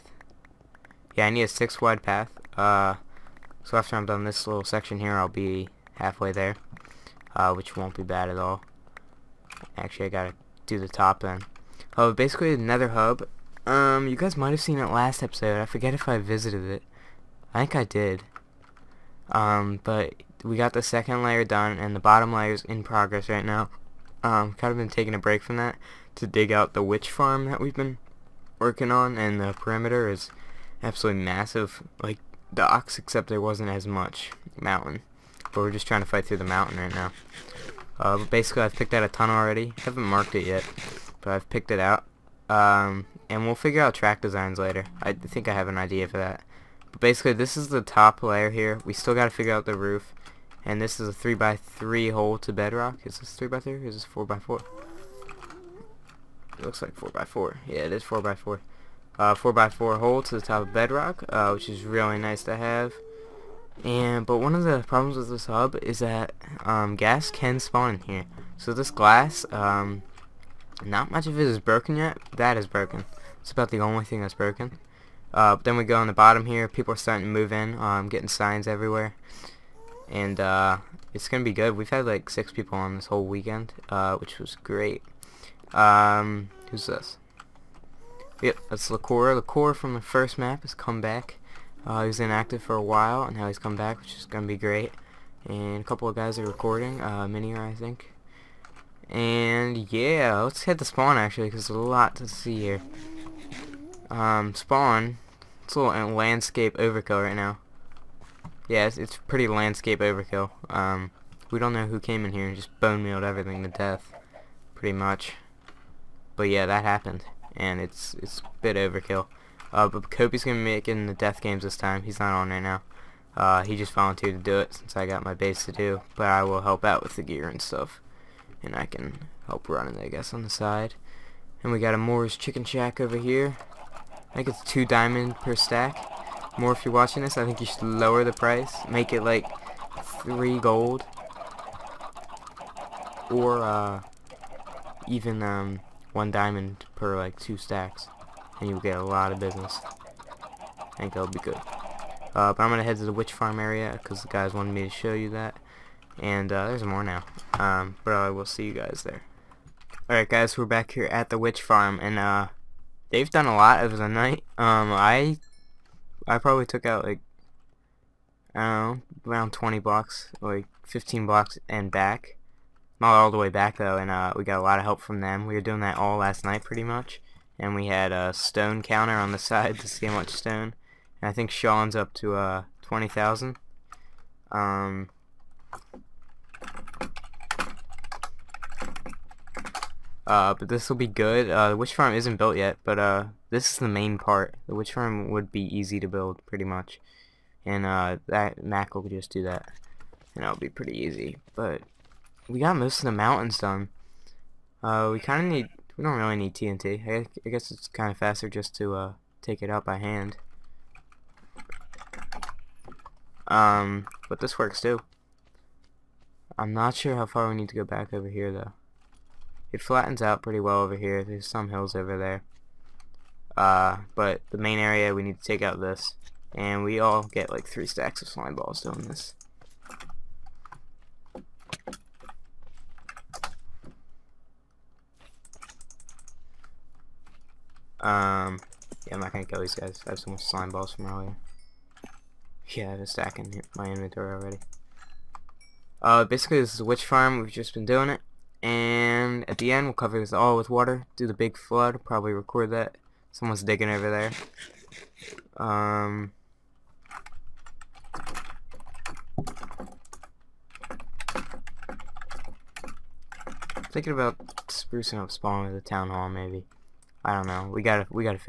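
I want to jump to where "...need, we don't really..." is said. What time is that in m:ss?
3:25.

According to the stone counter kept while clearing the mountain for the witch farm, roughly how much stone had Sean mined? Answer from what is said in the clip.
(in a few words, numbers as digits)
20,000.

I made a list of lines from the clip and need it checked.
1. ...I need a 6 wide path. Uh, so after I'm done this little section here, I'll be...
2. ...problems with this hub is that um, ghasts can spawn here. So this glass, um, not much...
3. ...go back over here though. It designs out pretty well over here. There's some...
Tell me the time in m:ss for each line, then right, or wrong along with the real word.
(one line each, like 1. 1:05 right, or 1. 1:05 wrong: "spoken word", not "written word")
1. 0:01 right
2. 1:04 right
3. 3:37 wrong: "flattens", not "designs".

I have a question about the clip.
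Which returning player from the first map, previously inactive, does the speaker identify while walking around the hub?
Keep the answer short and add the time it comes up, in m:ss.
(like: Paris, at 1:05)
Lacora, at 1:29.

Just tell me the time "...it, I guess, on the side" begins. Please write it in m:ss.
2:09.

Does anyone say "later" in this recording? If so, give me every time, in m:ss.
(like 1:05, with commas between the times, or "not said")
0:44.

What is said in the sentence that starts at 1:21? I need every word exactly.
We've had like six people on this whole weekend, uh, which was great.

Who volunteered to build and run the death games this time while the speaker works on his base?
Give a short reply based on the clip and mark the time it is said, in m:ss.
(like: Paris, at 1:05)
Kobe, at 2:00.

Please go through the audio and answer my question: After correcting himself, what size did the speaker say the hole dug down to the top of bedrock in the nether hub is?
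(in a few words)
4 by 4.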